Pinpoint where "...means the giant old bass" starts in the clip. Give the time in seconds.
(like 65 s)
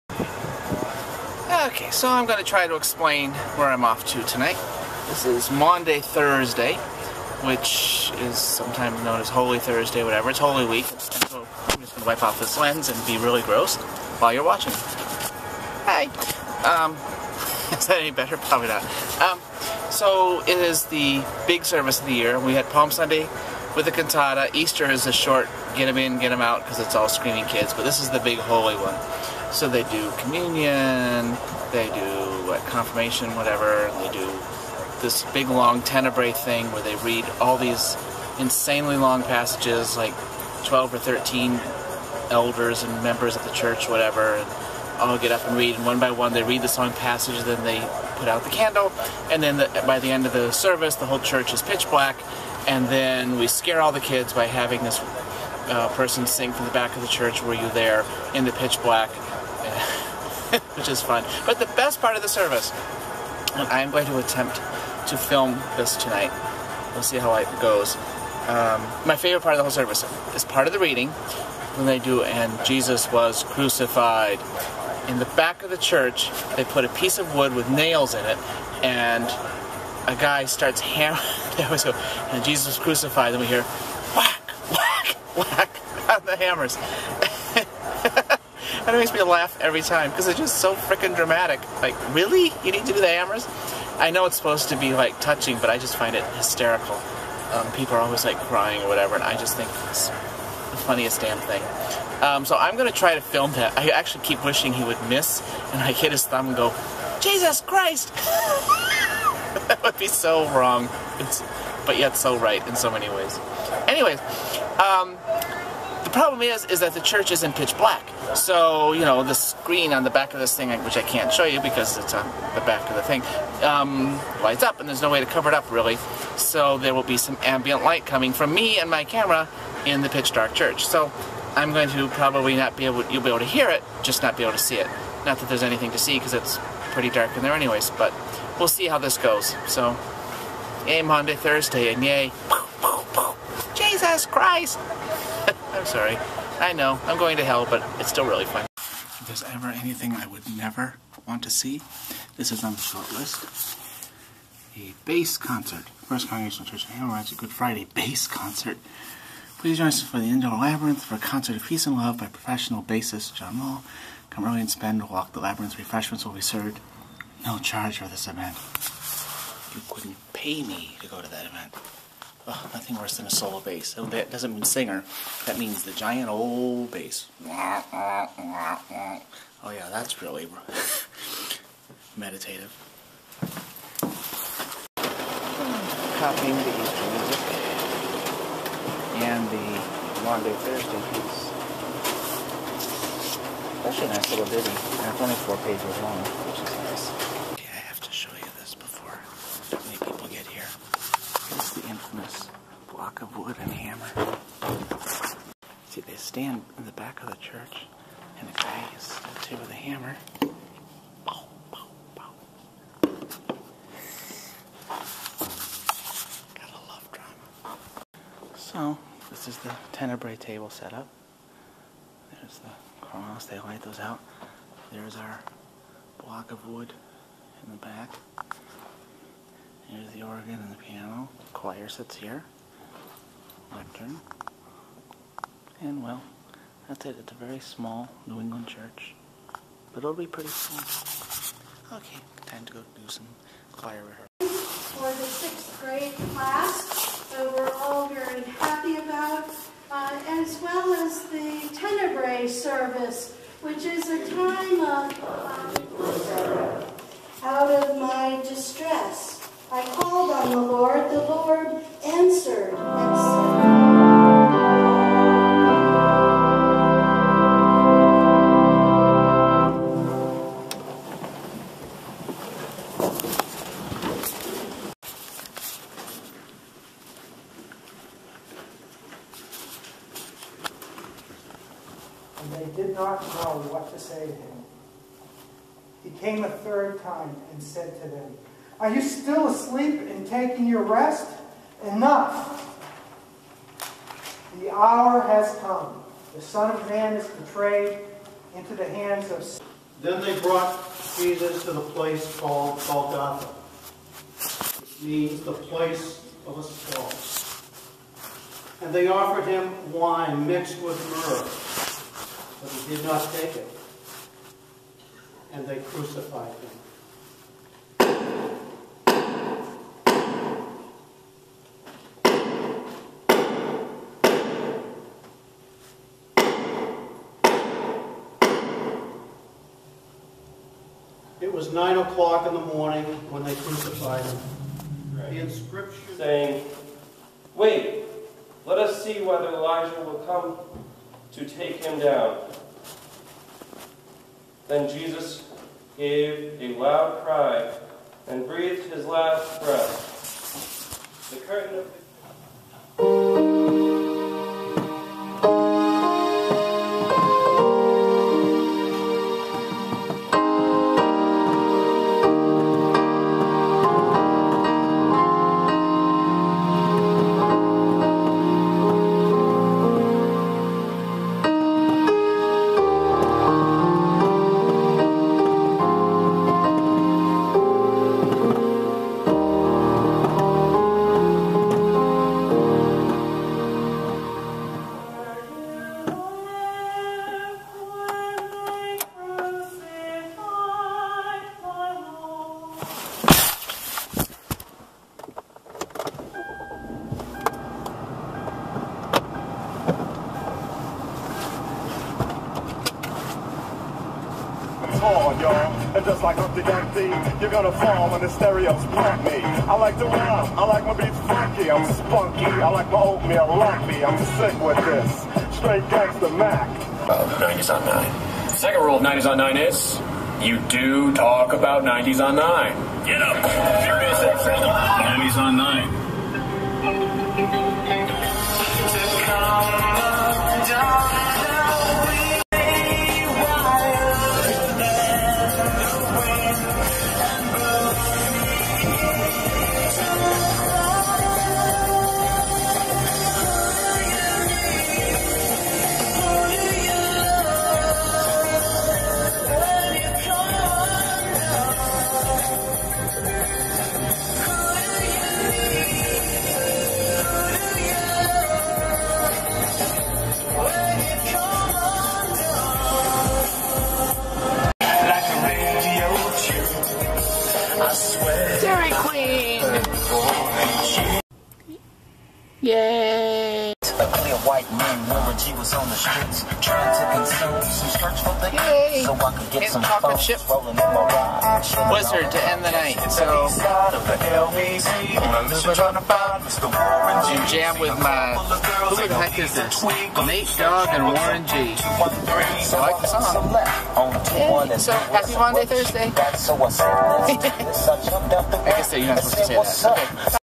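175 s.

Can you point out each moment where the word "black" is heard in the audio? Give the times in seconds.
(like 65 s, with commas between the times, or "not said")
51 s, 58 s, 117 s.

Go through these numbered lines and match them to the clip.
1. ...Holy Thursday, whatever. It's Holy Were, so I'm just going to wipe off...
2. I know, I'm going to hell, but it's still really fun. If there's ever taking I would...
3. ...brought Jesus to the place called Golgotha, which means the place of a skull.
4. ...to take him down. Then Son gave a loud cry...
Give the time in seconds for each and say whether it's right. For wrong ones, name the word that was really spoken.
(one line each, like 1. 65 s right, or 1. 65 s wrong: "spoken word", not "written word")
1. 9 s wrong: "Week", not "Were"
2. 146 s wrong: "anything", not "taking"
3. 300 s right
4. 341 s wrong: "Jesus", not "Son".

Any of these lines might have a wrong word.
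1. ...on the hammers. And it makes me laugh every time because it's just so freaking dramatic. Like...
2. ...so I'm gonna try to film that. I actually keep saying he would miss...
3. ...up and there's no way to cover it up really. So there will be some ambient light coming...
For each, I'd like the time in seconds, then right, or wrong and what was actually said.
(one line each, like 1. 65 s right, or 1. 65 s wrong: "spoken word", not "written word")
1. 86 s right
2. 102 s wrong: "wishing", not "saying"
3. 124 s right.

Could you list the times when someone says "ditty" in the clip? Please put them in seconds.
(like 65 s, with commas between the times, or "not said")
194 s.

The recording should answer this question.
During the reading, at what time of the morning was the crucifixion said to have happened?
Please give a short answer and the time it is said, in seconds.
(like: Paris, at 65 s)
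9 o'clock, at 331 s.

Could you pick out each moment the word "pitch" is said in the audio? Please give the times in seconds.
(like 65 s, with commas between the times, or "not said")
51 s, 58 s, 117 s, 130 s.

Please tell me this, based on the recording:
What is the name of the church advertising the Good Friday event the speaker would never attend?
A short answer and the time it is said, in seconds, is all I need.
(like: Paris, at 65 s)
First Congregational Church of Hammerheads, at 156 s.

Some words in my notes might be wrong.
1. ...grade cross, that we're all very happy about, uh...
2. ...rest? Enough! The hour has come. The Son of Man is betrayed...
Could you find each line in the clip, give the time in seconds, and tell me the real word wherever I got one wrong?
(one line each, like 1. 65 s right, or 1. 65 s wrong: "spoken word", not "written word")
1. 245 s wrong: "class", not "cross"
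2. 290 s right.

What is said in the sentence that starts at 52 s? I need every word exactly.
And then we scare all the kids by having this uh, person sing from the back of the church, Were you there?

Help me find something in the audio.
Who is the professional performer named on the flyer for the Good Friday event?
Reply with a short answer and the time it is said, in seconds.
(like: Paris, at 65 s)
John Wall, at 163 s.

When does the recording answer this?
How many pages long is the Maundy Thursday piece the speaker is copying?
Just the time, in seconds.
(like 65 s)
195 s.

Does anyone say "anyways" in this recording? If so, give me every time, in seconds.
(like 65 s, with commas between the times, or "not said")
113 s, 137 s.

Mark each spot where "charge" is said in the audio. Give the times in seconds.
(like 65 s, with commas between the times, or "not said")
167 s.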